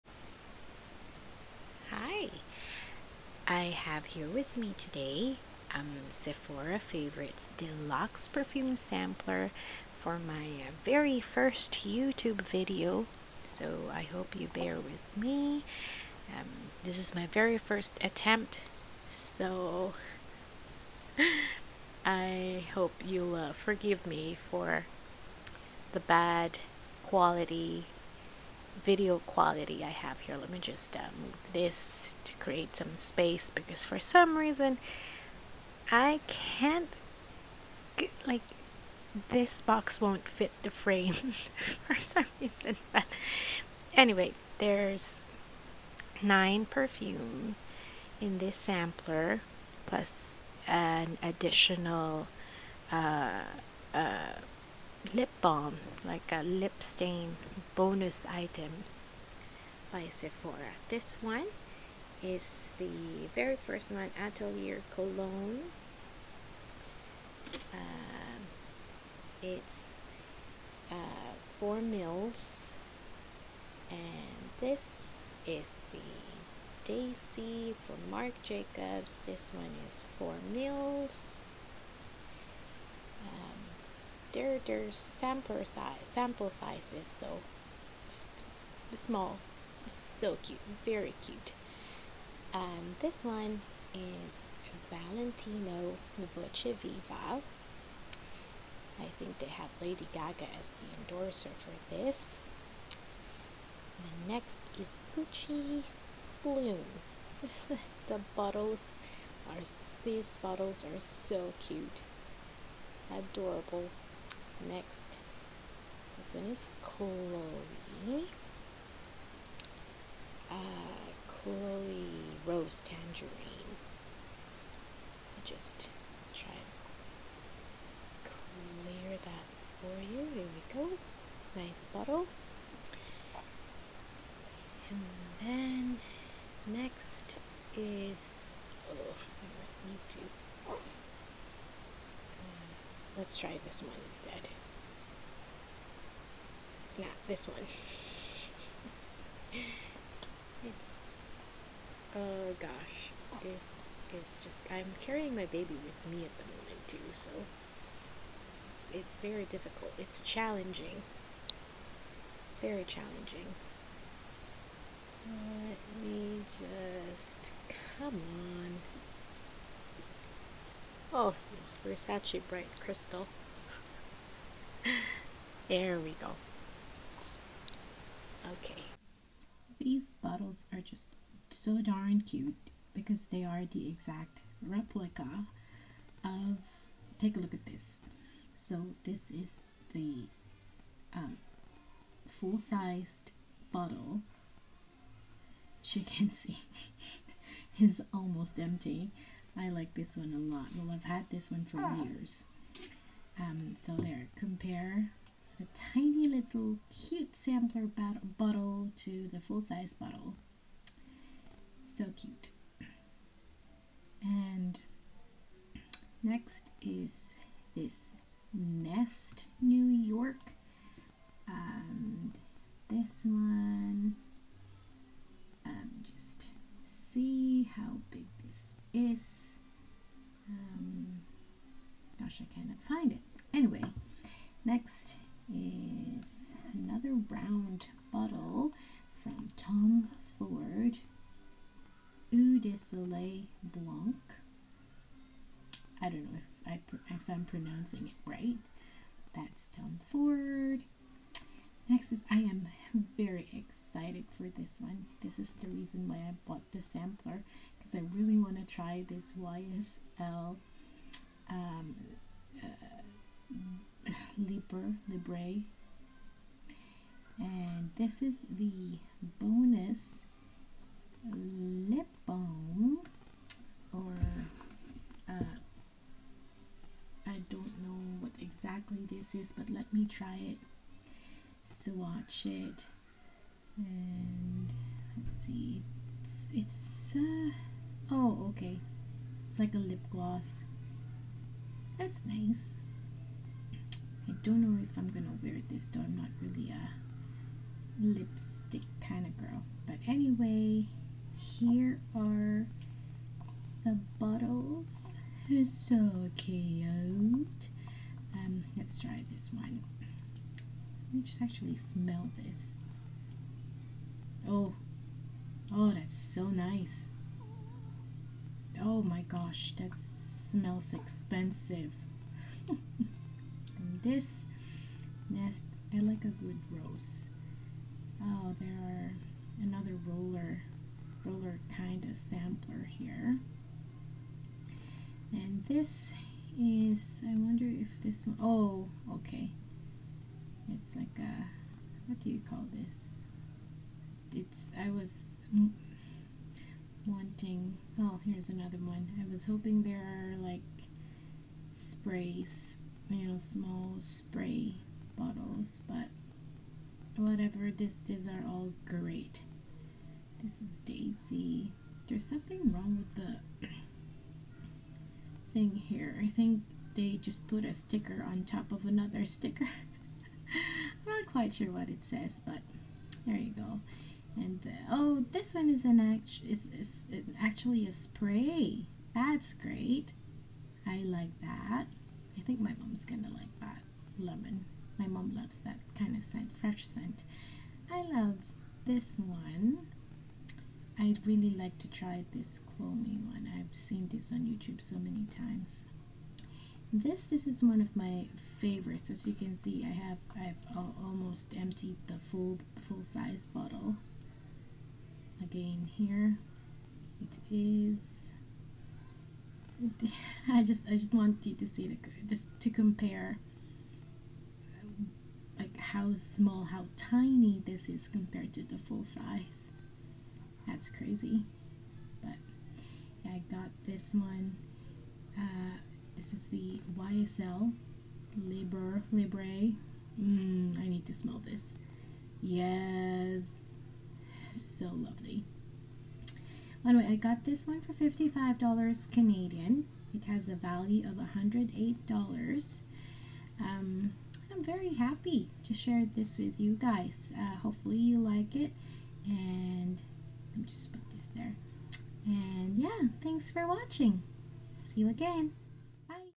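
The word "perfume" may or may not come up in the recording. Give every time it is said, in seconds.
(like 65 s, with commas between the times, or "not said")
8 s, 46 s.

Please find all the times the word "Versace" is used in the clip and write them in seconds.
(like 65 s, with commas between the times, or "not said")
172 s.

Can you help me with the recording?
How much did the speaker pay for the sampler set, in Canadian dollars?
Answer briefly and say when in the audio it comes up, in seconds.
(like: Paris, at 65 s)
$55, at 437 s.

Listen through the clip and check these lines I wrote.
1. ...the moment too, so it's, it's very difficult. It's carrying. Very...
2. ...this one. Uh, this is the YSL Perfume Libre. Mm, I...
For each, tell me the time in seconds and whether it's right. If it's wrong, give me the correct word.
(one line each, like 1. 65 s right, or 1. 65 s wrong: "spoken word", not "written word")
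1. 156 s wrong: "challenging", not "carrying"
2. 423 s wrong: "Libre", not "Perfume".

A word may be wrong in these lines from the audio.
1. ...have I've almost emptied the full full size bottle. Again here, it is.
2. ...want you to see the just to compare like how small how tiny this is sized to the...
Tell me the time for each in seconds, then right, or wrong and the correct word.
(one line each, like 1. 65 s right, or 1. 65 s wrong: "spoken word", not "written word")
1. 399 s right
2. 411 s wrong: "compared", not "sized".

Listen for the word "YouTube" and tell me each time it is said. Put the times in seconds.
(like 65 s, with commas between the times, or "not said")
11 s, 394 s.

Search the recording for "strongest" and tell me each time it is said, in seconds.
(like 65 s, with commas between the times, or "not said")
not said.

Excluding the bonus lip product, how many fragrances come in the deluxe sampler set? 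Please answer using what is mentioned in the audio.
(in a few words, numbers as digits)
9.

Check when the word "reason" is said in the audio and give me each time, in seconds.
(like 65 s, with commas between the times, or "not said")
34 s, 42 s, 255 s.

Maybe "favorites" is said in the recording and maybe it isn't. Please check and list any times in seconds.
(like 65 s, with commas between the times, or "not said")
6 s, 398 s.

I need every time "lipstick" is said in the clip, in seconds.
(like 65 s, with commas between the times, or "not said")
298 s.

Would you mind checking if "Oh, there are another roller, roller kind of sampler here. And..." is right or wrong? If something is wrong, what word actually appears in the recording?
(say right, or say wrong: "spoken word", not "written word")
right.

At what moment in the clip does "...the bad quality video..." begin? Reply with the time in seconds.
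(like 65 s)
25 s.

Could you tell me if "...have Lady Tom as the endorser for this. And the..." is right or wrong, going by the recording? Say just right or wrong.
wrong.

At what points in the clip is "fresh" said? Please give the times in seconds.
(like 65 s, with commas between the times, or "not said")
386 s.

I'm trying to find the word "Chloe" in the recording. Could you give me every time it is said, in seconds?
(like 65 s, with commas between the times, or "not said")
116 s, 121 s.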